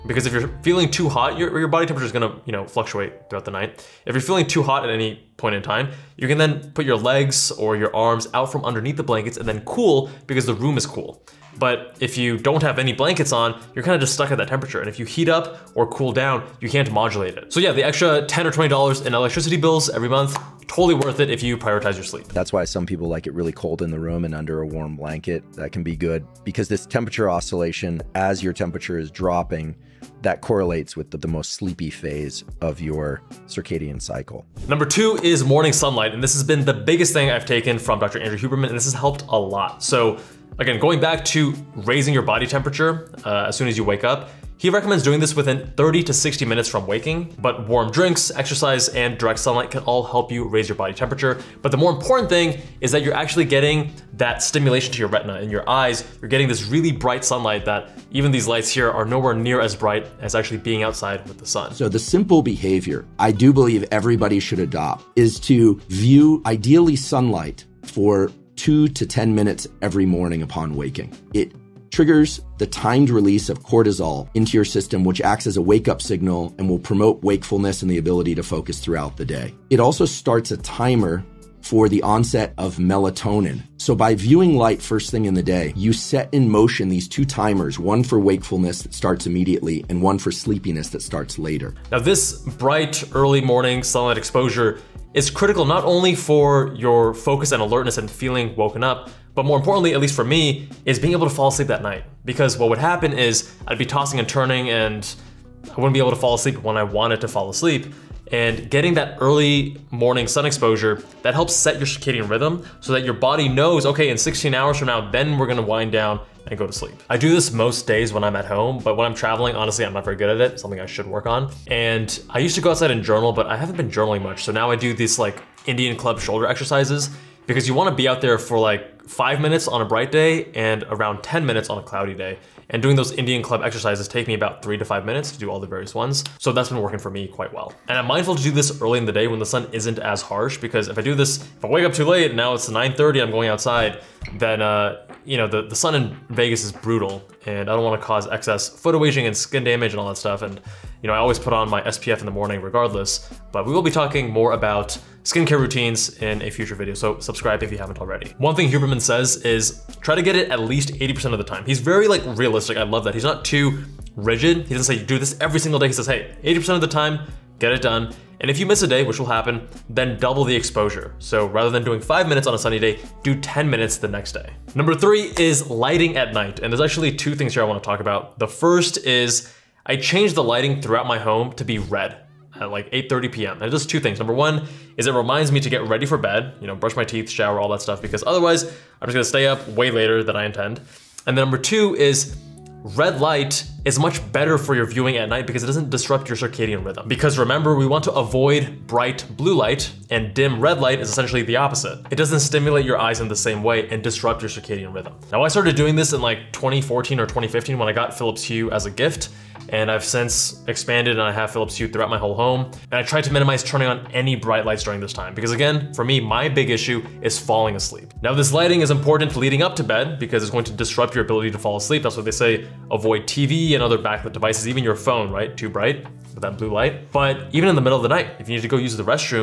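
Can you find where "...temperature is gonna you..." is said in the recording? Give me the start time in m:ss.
0:01.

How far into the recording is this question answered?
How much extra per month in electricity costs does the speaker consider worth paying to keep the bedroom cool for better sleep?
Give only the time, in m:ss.
0:18.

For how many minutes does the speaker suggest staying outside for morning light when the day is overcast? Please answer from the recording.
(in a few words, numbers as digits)
10 minutes.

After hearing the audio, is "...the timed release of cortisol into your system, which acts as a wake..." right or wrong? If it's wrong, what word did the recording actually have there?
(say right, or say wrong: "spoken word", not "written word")
right.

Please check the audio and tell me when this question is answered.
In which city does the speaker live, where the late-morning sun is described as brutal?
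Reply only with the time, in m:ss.
2:26.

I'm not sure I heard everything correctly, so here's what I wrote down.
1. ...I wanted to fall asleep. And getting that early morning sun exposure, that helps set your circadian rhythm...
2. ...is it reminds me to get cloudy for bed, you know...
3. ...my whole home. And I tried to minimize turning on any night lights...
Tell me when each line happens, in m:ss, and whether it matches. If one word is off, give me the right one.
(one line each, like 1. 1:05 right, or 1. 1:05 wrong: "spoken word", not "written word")
1. 1:46 right
2. 3:04 wrong: "ready", not "cloudy"
3. 3:32 wrong: "bright", not "night".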